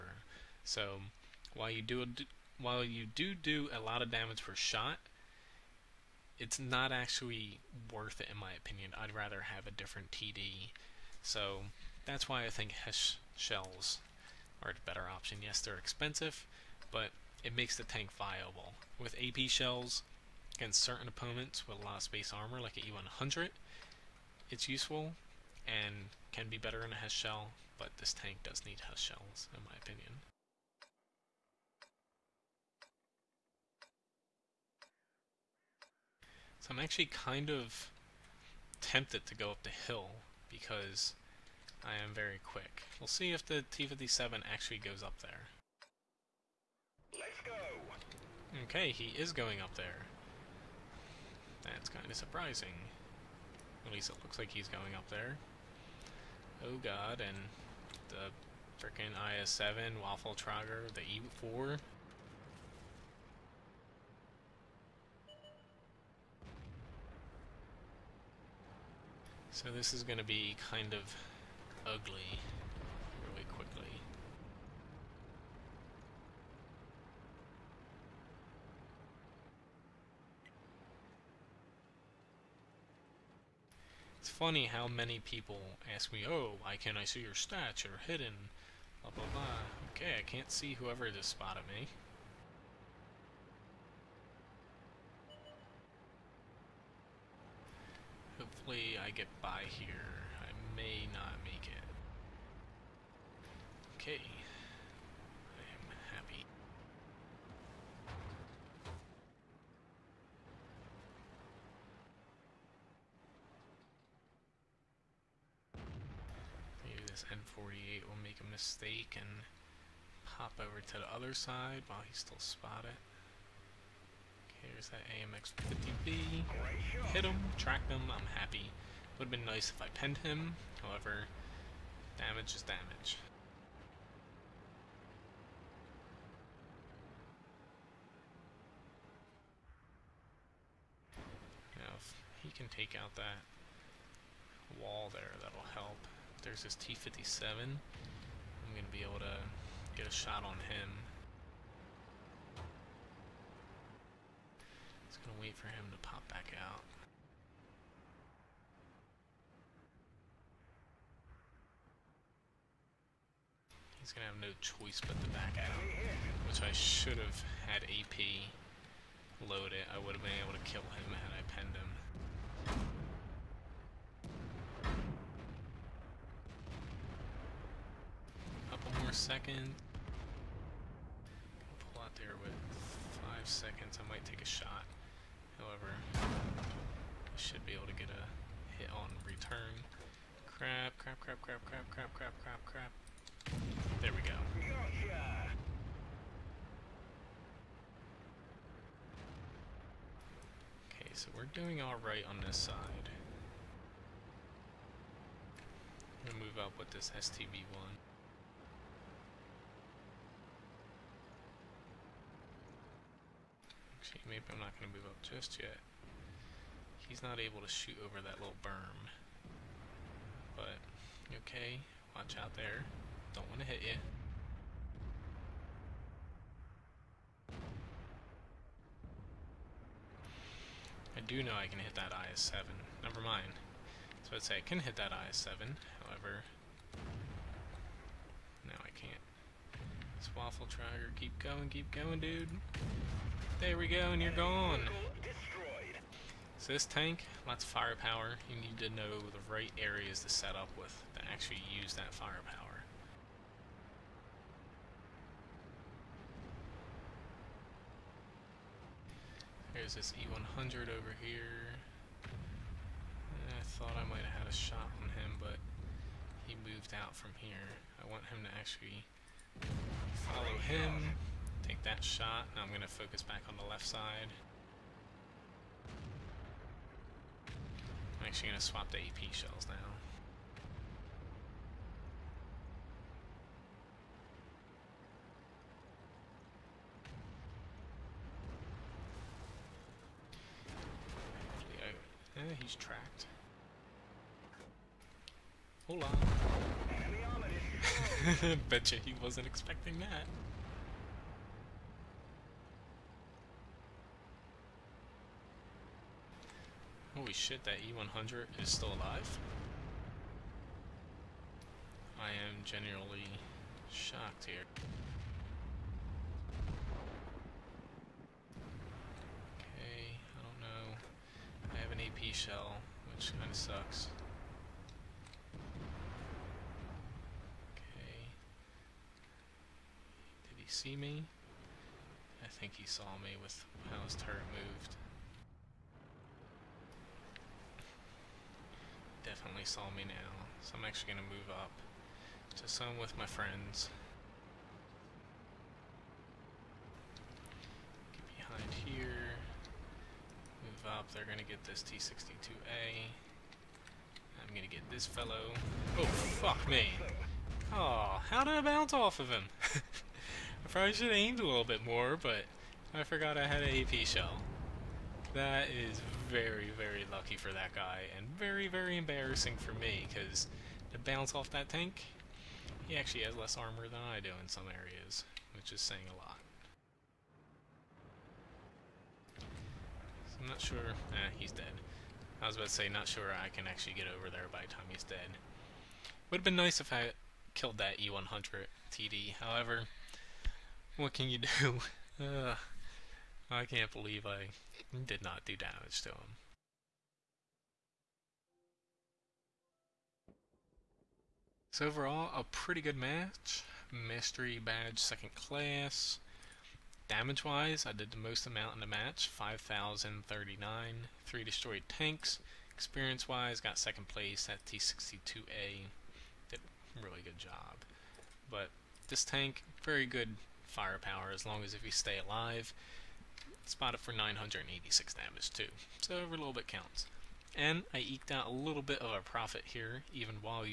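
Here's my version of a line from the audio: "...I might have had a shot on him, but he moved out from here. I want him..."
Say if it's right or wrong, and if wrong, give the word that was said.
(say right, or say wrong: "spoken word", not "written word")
right.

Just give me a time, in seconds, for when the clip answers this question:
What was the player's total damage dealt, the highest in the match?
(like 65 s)
409 s.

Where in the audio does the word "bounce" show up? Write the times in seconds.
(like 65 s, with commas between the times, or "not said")
358 s, 370 s.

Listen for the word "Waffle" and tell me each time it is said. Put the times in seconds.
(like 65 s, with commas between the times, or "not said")
60 s, 240 s.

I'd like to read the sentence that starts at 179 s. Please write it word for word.
Second, Pull out there with five seconds.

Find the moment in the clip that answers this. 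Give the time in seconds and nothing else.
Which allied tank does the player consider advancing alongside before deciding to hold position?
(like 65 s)
207 s.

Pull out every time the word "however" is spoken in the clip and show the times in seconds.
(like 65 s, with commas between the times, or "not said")
130 s, 185 s, 236 s, 389 s.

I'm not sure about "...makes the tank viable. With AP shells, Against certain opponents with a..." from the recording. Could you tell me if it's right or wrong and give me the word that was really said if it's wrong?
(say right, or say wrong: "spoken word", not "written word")
right.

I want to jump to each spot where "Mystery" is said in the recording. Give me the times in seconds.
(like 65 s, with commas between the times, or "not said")
403 s.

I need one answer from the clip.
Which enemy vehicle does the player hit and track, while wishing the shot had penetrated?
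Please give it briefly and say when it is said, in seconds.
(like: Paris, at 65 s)
AMX 50B, at 125 s.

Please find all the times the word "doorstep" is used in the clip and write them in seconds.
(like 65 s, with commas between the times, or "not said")
not said.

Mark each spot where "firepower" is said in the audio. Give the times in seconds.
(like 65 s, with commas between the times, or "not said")
247 s, 252 s, 420 s.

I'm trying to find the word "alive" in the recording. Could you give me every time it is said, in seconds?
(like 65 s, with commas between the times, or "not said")
308 s, 422 s.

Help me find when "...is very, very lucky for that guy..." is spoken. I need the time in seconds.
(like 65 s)
365 s.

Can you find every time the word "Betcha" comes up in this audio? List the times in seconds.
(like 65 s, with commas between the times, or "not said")
298 s.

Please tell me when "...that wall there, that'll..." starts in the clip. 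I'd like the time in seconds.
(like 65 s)
143 s.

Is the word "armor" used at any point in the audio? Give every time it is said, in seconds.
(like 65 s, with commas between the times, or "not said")
22 s, 373 s.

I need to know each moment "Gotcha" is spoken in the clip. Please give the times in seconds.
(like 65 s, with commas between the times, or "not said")
194 s.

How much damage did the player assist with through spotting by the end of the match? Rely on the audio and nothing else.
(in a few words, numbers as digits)
986.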